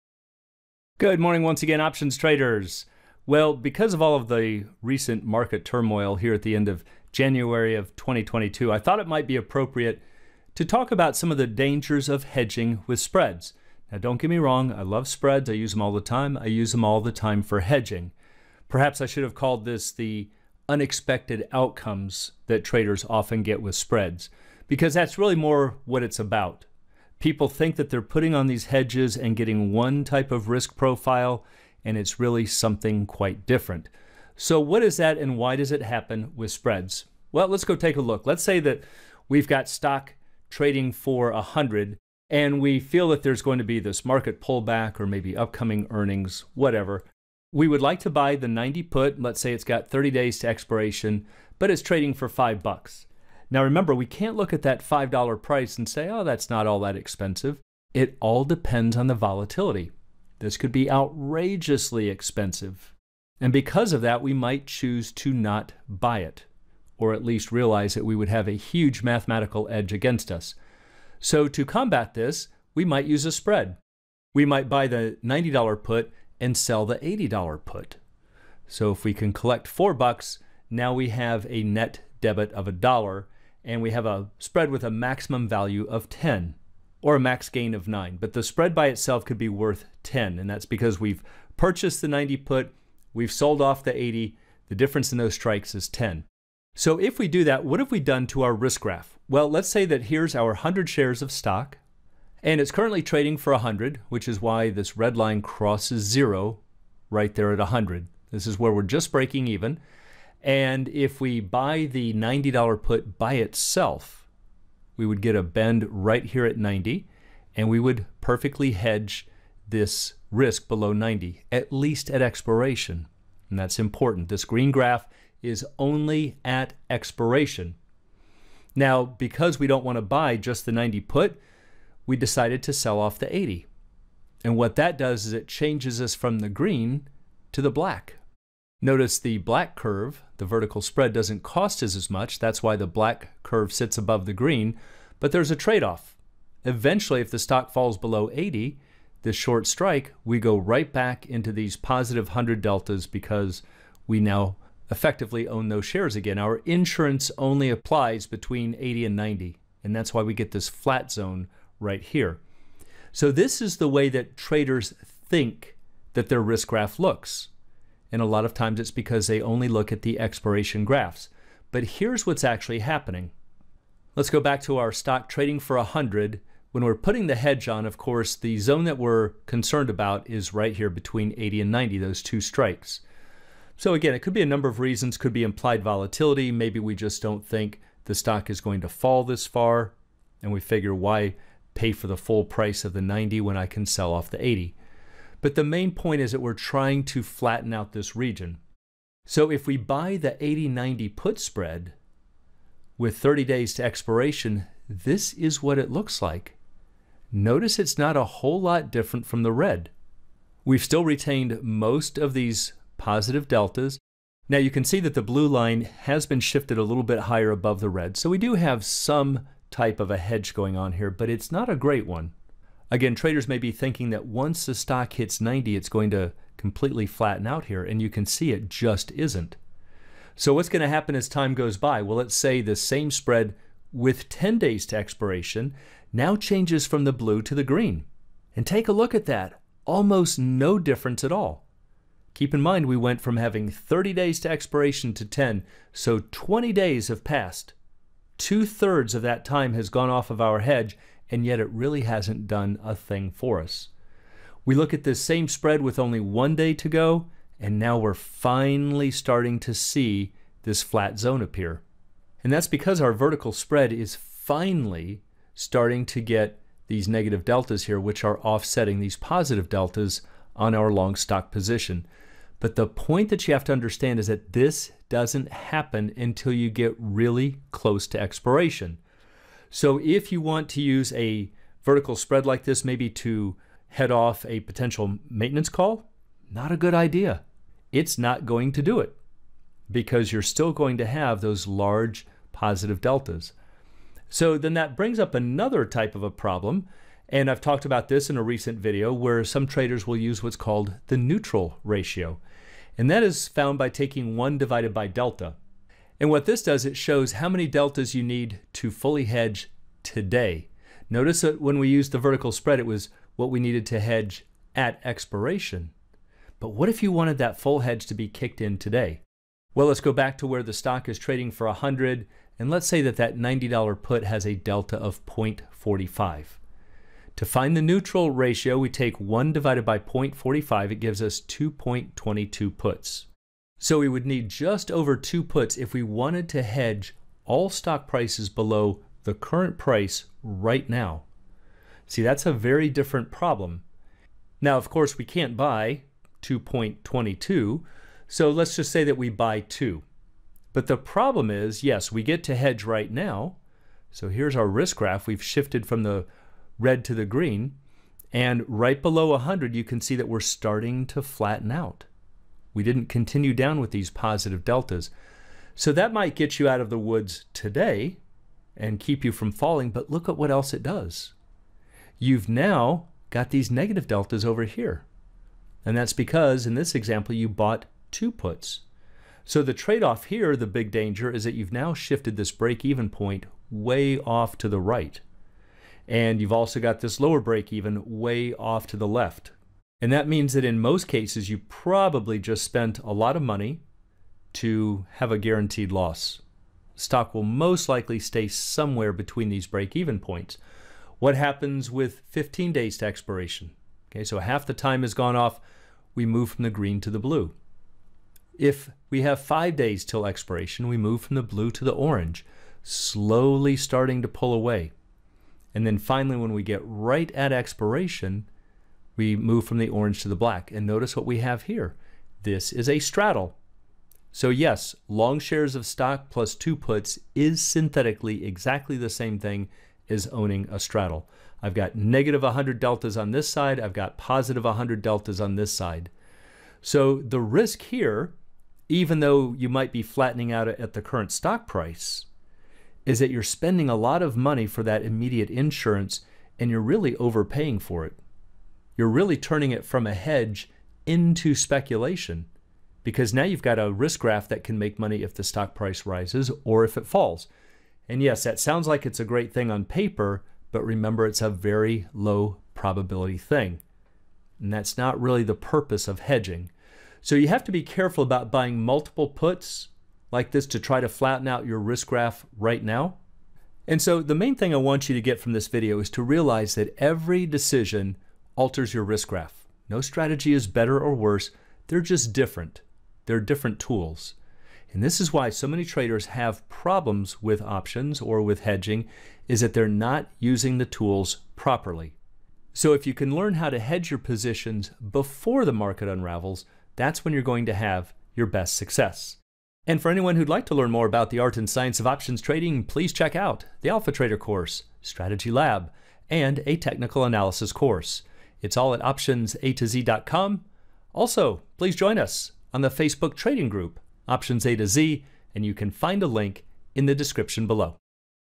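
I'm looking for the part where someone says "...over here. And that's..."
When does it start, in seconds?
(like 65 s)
374 s.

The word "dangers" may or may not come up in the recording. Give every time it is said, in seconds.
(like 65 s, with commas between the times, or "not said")
11 s, 380 s.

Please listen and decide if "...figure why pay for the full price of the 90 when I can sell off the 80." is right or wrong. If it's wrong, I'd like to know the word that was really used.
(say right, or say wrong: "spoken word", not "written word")
right.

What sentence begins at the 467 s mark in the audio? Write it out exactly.
So you have to be careful about buying multiple puts like this to try to flatten out your risk graph right now.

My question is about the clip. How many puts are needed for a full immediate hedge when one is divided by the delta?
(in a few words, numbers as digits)
2.22.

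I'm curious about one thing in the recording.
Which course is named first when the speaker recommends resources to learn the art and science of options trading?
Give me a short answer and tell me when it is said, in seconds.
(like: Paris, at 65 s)
Alpha Trader, at 503 s.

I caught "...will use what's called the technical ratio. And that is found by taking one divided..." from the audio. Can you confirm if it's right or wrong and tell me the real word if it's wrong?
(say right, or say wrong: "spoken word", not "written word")
wrong: "neutral", not "technical".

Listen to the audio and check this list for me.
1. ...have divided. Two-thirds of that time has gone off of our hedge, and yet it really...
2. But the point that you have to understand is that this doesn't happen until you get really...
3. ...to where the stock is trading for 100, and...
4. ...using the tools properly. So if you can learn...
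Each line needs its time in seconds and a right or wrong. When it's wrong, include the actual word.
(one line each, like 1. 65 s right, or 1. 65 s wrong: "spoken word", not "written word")
1. 247 s wrong: "passed", not "divided"
2. 272 s right
3. 320 s right
4. 490 s right.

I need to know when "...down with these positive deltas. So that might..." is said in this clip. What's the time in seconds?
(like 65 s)
363 s.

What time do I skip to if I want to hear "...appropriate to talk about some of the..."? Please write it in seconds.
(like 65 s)
9 s.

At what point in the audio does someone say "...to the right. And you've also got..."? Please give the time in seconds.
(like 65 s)
384 s.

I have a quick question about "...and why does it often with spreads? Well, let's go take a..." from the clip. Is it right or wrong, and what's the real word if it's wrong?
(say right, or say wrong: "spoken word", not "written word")
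wrong: "happen", not "often".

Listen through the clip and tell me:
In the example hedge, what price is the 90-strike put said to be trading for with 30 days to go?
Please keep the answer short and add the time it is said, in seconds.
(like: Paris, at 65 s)
$5, at 52 s.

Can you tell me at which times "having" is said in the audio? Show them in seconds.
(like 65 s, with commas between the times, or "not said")
243 s.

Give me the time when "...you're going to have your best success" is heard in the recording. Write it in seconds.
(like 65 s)
497 s.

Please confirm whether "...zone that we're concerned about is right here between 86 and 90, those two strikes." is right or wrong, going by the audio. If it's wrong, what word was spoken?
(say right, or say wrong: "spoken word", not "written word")
wrong: "80", not "86".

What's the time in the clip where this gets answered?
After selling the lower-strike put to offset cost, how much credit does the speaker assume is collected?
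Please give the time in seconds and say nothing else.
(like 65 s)
79 s.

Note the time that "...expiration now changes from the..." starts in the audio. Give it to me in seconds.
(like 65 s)
234 s.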